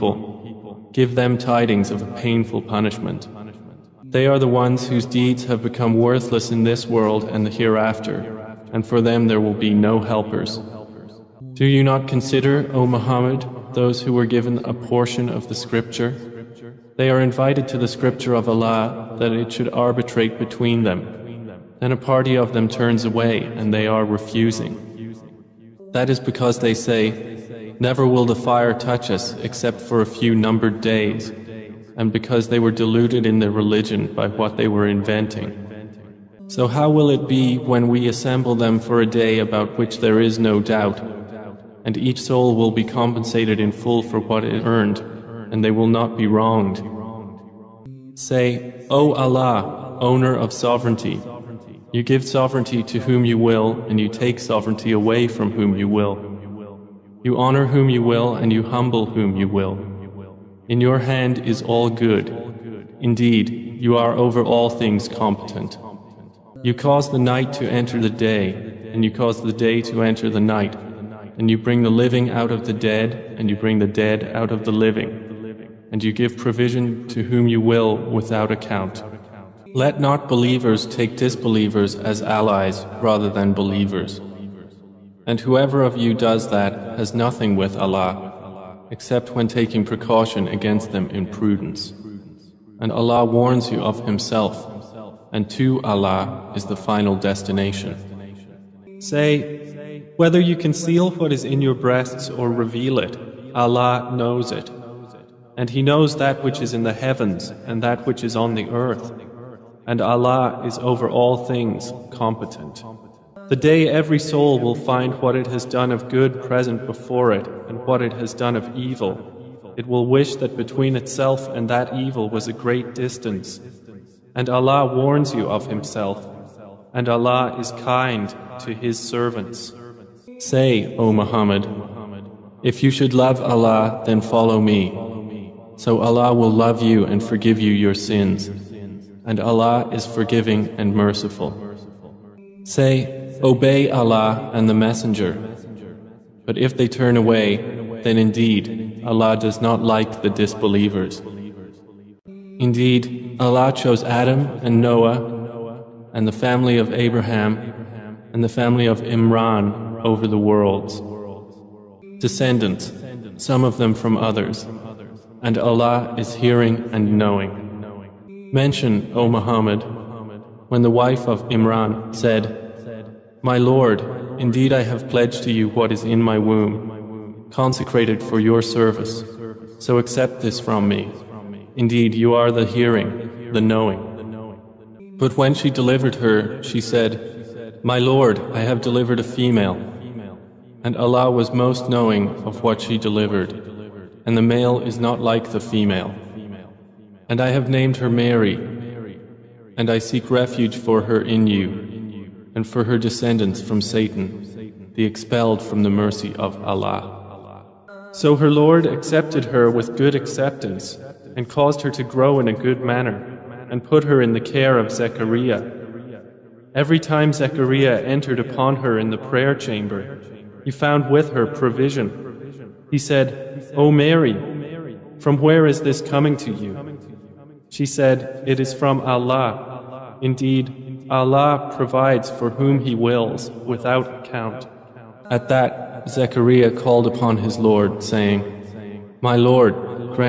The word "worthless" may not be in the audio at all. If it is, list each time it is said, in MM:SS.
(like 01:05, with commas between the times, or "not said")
00:05.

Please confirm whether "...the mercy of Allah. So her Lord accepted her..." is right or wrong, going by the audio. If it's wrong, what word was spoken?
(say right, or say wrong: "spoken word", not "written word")
right.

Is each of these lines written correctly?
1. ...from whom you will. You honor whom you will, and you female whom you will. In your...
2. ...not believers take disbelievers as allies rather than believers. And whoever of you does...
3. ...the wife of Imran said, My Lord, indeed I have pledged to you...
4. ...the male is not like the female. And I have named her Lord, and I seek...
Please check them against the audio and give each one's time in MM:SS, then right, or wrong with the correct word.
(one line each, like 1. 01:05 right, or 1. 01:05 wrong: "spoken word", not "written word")
1. 00:55 wrong: "humble", not "female"
2. 01:19 right
3. 02:50 right
4. 03:14 wrong: "Mary", not "Lord".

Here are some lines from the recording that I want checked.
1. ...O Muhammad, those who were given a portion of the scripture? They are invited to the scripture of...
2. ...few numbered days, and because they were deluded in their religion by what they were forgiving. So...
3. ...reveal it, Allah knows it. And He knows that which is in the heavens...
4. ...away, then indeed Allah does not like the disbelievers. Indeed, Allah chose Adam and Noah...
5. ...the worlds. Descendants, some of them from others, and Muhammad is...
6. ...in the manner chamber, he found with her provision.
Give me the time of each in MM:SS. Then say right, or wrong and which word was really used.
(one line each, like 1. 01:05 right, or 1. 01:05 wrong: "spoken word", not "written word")
1. 00:12 right
2. 00:30 wrong: "inventing", not "forgiving"
3. 01:42 right
4. 02:27 right
5. 02:40 wrong: "Allah", not "Muhammad"
6. 03:38 wrong: "prayer", not "manner".